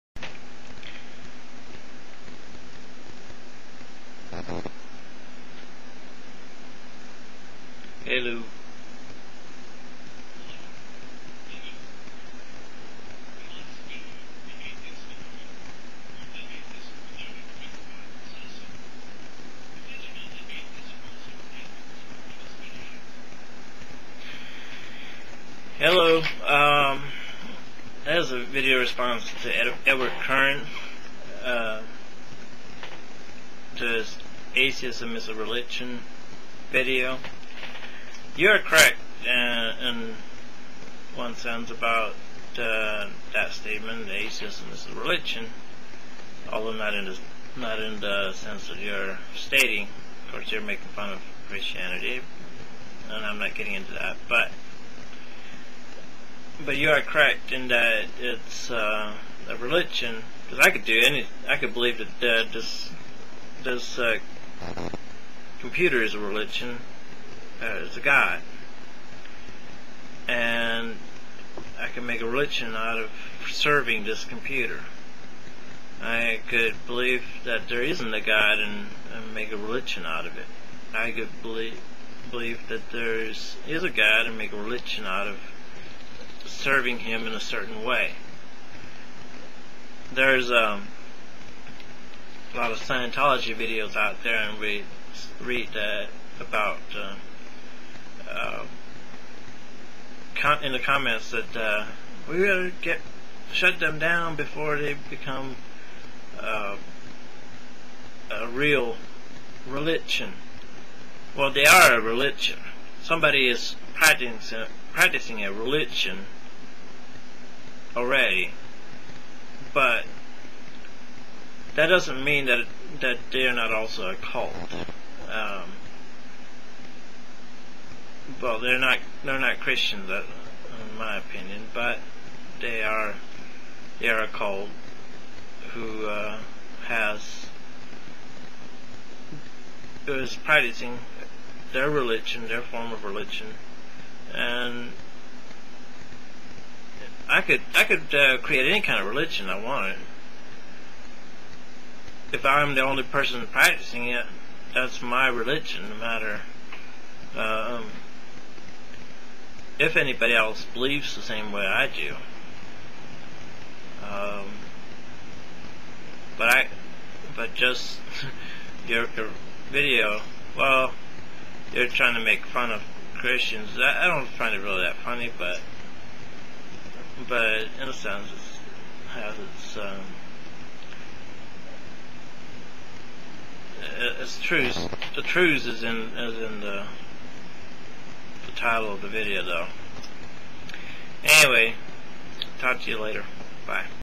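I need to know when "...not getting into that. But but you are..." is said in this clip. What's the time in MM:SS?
00:53.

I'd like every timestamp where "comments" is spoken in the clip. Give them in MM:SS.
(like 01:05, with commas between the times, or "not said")
01:40.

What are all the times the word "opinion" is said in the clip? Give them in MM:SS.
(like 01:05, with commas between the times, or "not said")
02:11.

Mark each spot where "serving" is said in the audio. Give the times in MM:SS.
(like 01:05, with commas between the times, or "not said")
01:13, 01:26.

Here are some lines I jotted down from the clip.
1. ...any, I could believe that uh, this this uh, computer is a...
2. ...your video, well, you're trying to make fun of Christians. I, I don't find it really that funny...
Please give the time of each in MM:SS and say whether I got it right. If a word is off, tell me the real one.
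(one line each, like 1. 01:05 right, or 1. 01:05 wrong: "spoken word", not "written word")
1. 01:01 right
2. 02:49 right.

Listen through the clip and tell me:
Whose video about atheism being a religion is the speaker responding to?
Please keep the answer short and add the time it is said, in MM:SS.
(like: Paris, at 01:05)
Edward Current, at 00:29.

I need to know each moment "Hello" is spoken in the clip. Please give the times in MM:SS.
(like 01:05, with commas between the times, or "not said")
00:08, 00:25.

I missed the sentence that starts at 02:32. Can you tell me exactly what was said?
If I'm the only person practicing it, that's my religion, no matter.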